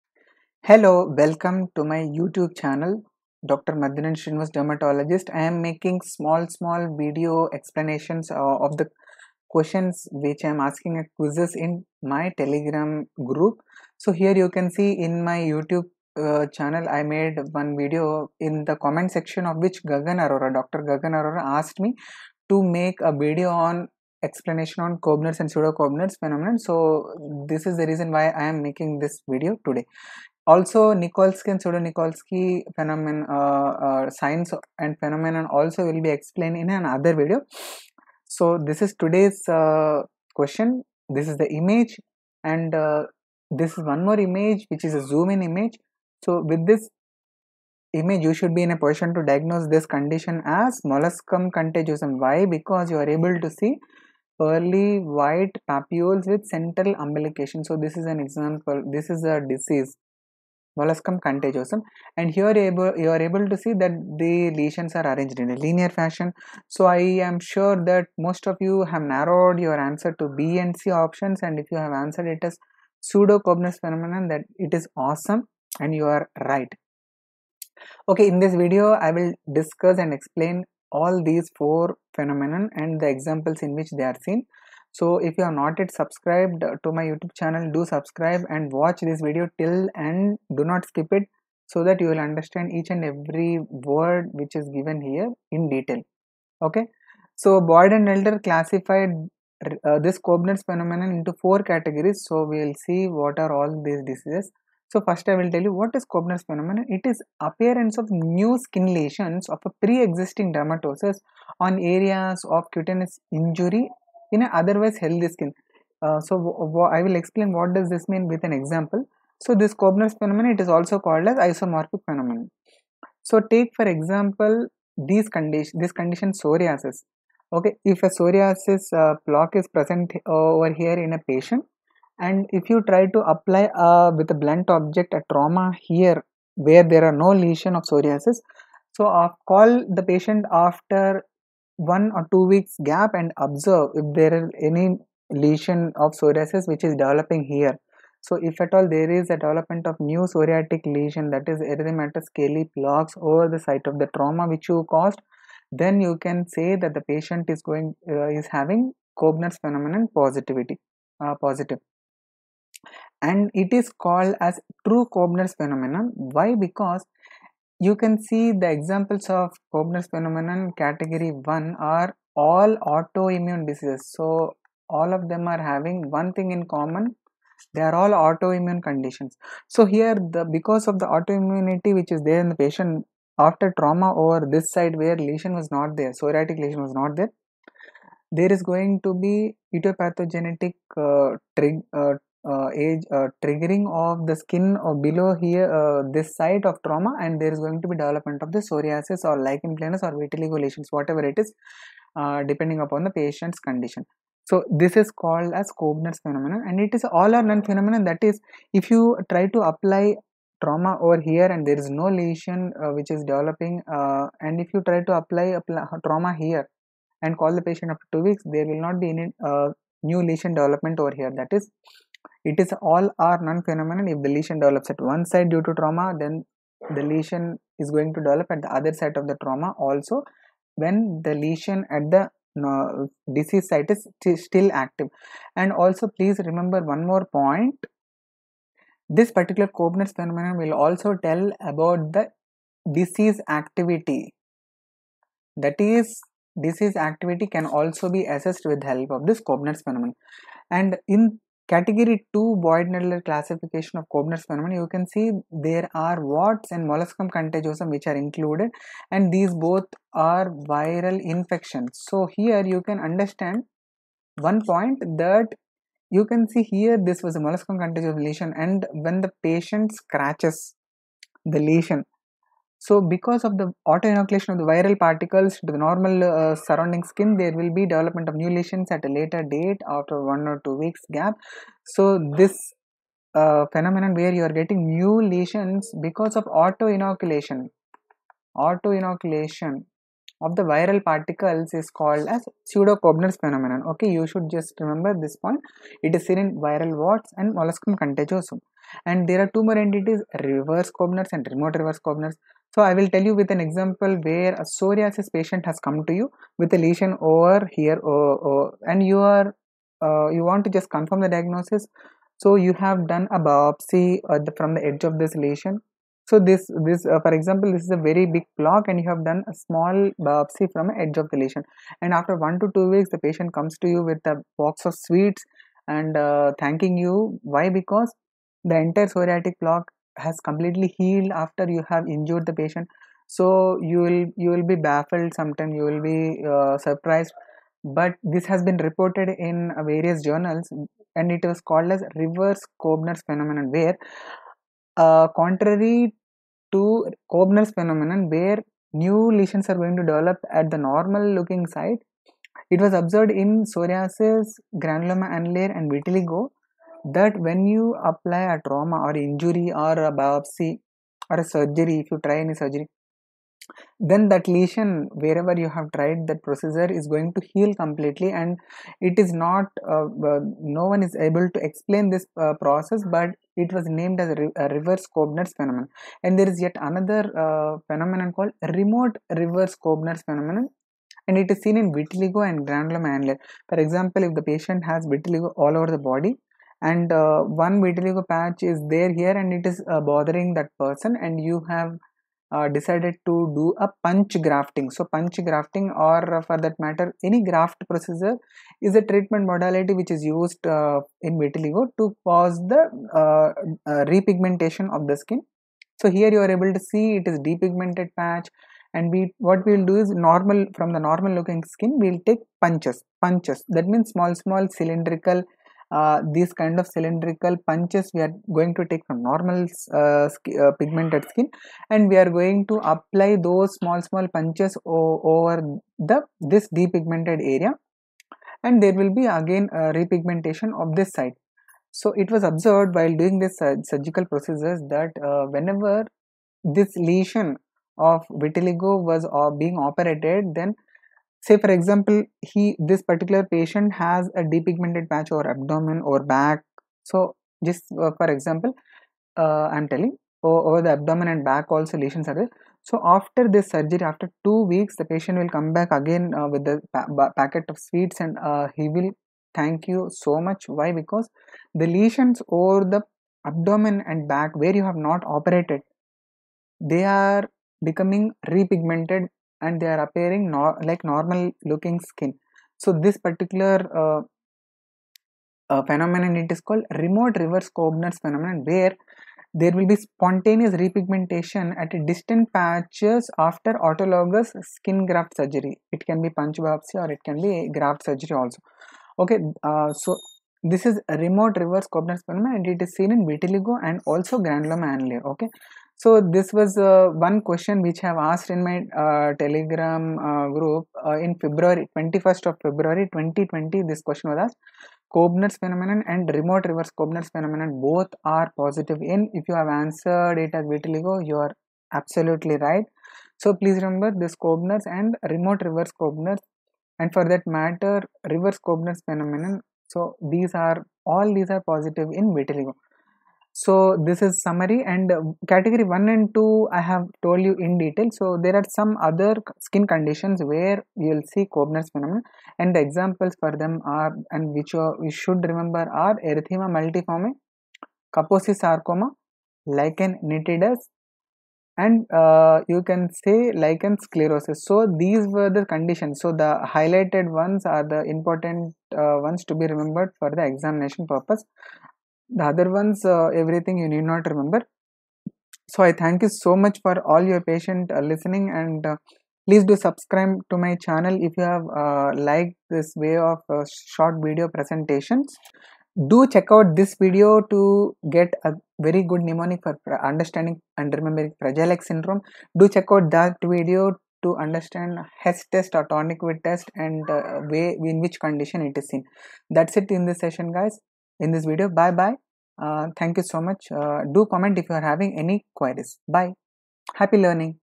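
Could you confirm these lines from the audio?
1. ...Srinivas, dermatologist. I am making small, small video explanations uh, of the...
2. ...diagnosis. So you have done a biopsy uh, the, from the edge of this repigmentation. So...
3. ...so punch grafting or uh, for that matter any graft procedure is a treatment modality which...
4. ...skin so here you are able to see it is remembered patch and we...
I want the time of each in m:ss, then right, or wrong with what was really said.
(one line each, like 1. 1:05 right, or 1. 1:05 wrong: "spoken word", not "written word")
1. 0:04 right
2. 5:11 wrong: "lesion", not "repigmentation"
3. 6:34 right
4. 6:45 wrong: "depigmented", not "remembered".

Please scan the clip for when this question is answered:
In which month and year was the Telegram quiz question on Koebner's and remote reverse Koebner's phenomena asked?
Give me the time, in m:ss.
8:22.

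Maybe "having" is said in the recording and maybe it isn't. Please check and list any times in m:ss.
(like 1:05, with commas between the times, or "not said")
2:38, 2:55, 9:44.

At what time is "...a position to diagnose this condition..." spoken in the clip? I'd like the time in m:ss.
0:48.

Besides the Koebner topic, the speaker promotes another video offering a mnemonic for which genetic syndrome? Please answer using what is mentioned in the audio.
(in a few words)
Fragile X syndrome.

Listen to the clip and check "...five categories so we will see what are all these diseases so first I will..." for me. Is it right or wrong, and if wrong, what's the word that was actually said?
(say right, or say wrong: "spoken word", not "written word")
wrong: "four", not "five".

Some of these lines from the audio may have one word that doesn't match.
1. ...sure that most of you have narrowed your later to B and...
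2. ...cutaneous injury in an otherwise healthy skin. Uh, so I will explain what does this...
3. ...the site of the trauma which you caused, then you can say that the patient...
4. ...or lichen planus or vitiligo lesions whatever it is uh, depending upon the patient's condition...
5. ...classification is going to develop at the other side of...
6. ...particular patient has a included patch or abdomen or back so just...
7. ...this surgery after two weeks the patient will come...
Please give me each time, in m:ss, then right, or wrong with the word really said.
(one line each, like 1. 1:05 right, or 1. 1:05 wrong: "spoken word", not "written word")
1. 1:07 wrong: "answer", not "later"
2. 1:52 right
3. 2:33 right
4. 3:19 right
5. 3:47 wrong: "lesion", not "classification"
6. 7:23 wrong: "depigmented", not "included"
7. 7:33 right.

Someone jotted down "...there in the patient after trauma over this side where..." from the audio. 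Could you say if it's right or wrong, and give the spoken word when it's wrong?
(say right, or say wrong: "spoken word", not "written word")
right.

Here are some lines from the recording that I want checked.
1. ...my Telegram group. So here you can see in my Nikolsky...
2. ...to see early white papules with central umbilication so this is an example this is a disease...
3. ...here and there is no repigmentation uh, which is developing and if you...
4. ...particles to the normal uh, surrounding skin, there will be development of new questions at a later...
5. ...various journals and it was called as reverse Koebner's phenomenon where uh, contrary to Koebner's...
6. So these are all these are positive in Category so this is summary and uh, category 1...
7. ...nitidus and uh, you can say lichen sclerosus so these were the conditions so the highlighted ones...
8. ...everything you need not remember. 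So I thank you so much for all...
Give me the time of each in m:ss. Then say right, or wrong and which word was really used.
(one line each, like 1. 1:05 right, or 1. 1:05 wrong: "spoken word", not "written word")
1. 0:12 wrong: "YouTube", not "Nikolsky"
2. 0:53 right
3. 3:31 wrong: "lesion", not "repigmentation"
4. 4:35 wrong: "lesions", not "questions"
5. 5:39 right
6. 8:39 wrong: "Vitiligo", not "Category"
7. 9:00 right
8. 9:13 right.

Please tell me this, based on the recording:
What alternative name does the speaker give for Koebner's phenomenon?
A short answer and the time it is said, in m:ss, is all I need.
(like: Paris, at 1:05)
isomorphic phenomenon, at 2:01.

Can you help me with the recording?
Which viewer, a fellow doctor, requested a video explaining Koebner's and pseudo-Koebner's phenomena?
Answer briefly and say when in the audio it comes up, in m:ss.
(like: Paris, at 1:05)
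Dr. Gagan Arora, at 0:20.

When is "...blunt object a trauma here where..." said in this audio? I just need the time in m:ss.
2:14.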